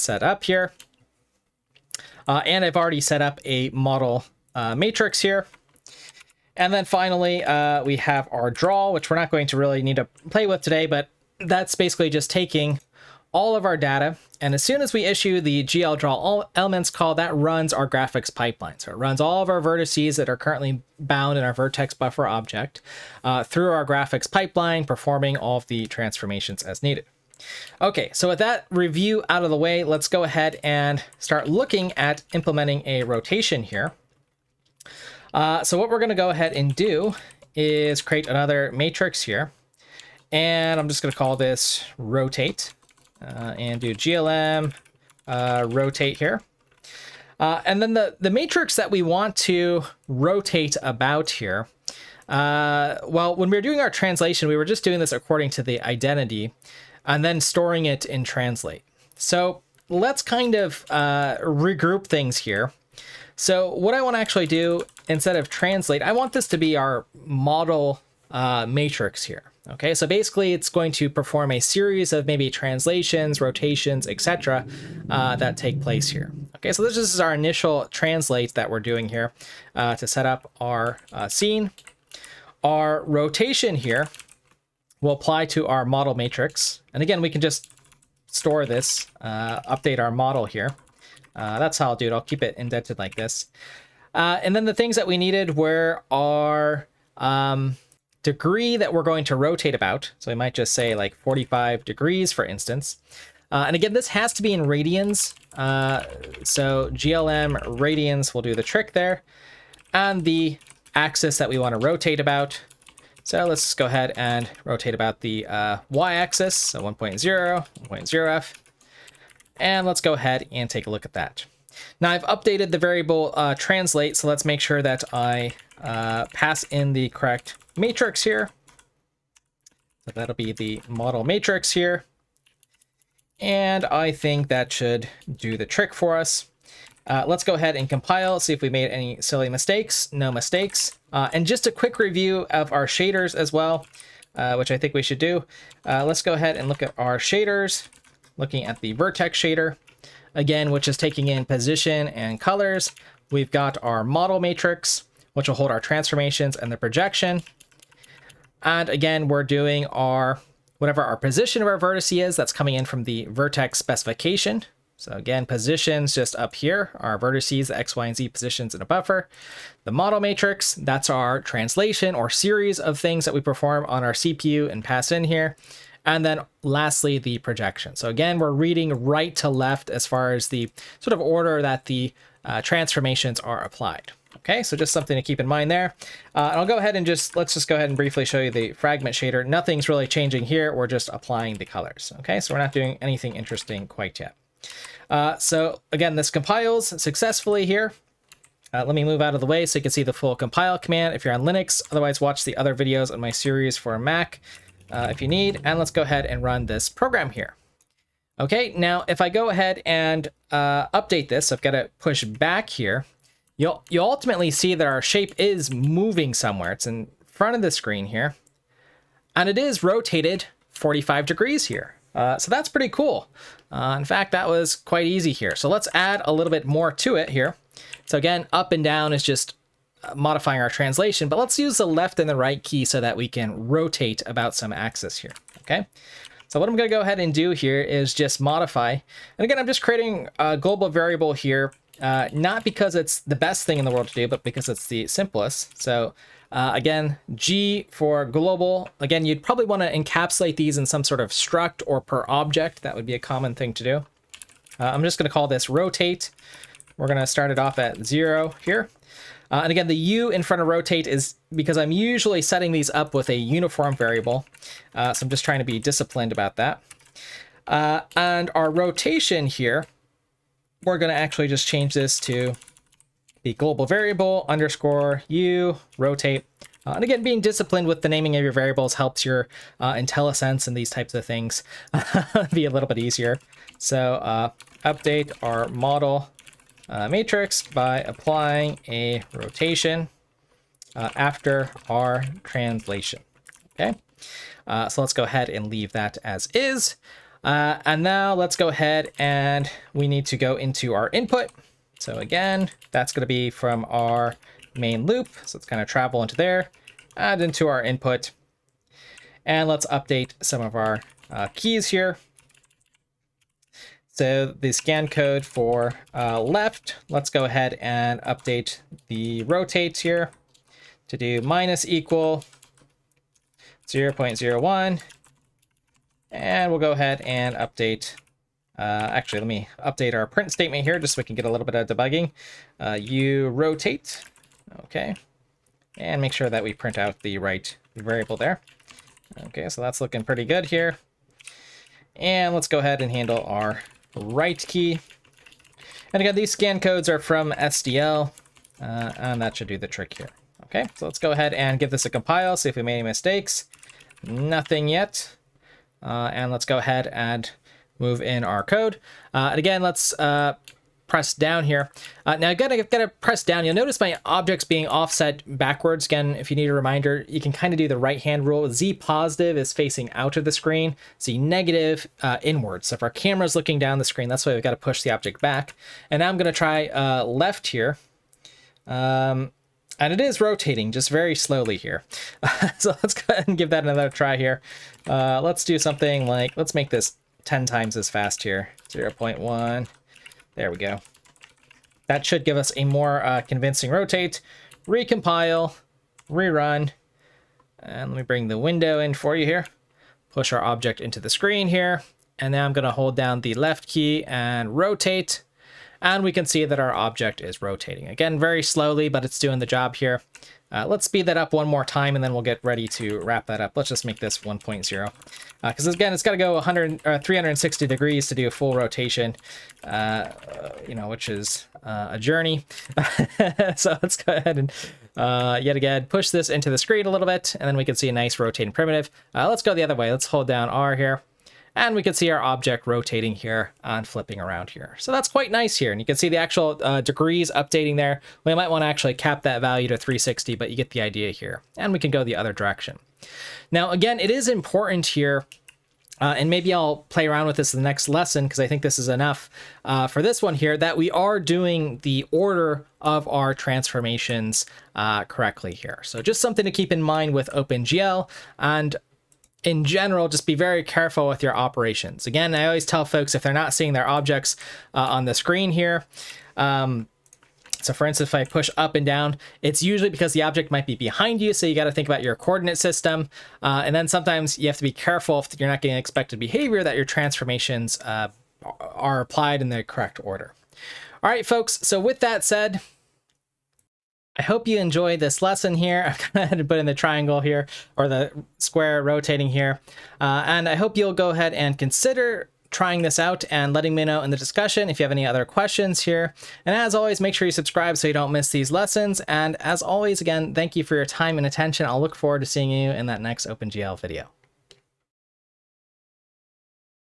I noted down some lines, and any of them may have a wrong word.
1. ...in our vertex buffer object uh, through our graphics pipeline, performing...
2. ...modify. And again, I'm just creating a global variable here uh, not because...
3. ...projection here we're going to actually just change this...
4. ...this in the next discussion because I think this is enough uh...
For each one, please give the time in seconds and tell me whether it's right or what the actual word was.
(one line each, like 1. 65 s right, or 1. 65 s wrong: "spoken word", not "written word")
1. 21 s right
2. 238 s right
3. 268 s wrong: "rotation", not "projection"
4. 447 s wrong: "lesson", not "discussion".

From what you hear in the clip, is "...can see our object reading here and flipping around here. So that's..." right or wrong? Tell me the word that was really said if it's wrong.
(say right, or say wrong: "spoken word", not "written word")
wrong: "rotating", not "reading".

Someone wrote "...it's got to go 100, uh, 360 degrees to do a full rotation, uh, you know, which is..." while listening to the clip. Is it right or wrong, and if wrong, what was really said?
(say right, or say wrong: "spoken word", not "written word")
right.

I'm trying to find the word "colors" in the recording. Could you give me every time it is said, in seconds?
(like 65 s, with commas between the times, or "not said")
152 s, 191 s.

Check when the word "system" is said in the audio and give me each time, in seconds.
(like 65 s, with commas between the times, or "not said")
472 s.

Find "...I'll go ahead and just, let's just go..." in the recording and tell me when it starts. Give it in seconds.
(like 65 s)
186 s.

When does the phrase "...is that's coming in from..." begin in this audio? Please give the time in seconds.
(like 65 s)
162 s.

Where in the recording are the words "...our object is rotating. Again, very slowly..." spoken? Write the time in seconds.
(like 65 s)
406 s.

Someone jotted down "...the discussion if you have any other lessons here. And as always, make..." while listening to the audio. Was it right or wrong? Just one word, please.
wrong.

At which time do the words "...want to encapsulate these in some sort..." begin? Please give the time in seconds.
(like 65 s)
249 s.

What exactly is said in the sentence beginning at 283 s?
So uh, update our model uh, matrix by applying a rotation uh, after our translation.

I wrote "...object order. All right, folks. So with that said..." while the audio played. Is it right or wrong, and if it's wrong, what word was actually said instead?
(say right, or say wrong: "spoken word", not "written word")
wrong: "correct", not "object".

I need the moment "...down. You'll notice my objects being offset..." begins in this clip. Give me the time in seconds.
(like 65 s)
363 s.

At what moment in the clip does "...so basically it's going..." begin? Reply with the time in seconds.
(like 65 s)
69 s.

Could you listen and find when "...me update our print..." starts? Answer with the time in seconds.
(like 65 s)
329 s.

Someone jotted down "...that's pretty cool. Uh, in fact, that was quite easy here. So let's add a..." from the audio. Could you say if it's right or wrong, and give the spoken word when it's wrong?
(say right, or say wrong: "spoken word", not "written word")
right.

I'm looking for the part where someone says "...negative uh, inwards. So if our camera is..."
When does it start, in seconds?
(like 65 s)
371 s.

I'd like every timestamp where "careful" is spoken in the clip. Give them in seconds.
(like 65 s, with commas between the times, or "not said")
460 s, 474 s.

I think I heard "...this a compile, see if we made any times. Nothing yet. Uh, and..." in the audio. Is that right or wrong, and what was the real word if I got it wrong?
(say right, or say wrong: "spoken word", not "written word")
wrong: "mistakes", not "times".